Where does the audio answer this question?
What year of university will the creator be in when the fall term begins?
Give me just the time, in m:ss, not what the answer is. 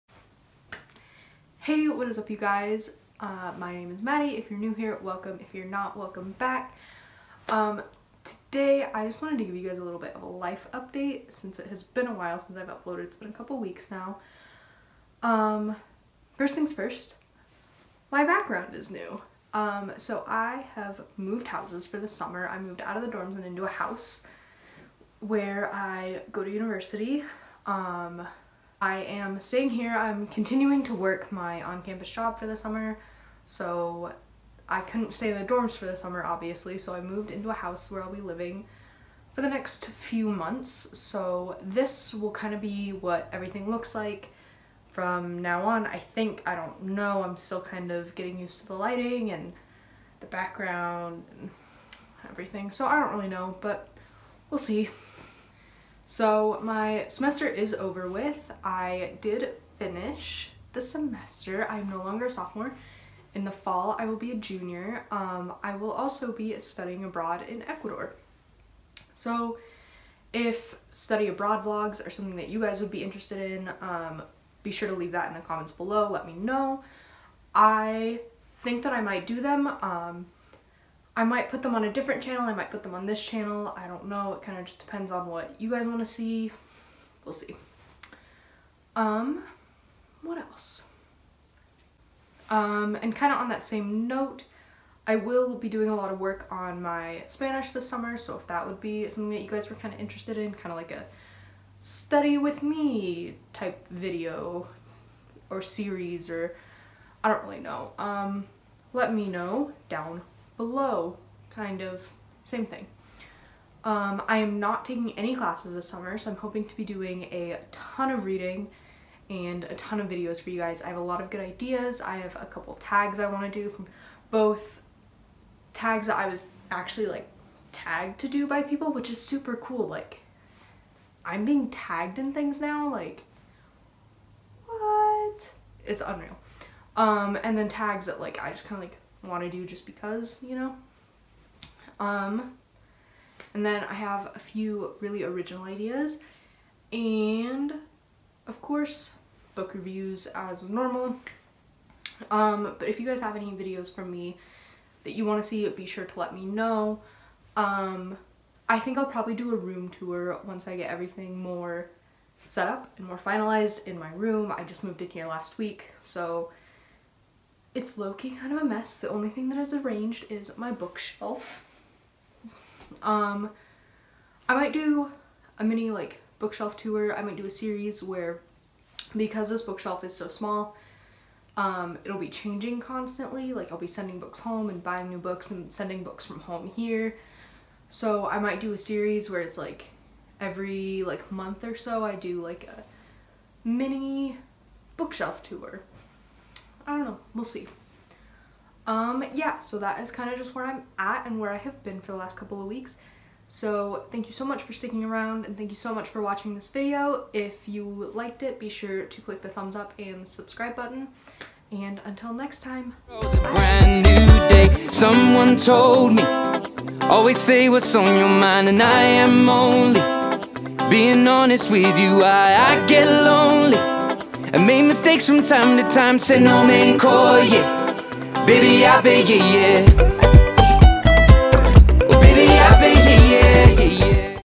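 1:04.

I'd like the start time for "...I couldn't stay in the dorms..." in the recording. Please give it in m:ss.
0:34.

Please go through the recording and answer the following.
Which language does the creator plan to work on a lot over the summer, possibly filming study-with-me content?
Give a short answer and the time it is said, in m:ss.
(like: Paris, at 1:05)
Spanish, at 1:37.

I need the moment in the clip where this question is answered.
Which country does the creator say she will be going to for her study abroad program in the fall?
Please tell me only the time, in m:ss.
1:07.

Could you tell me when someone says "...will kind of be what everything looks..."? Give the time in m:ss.
0:42.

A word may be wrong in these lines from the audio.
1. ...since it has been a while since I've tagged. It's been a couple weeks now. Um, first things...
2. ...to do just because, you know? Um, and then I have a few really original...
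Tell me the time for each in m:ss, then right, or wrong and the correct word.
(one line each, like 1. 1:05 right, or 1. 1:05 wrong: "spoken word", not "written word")
1. 0:11 wrong: "uploaded", not "tagged"
2. 2:19 right.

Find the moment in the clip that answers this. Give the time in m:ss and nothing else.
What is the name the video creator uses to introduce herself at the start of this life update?
0:04.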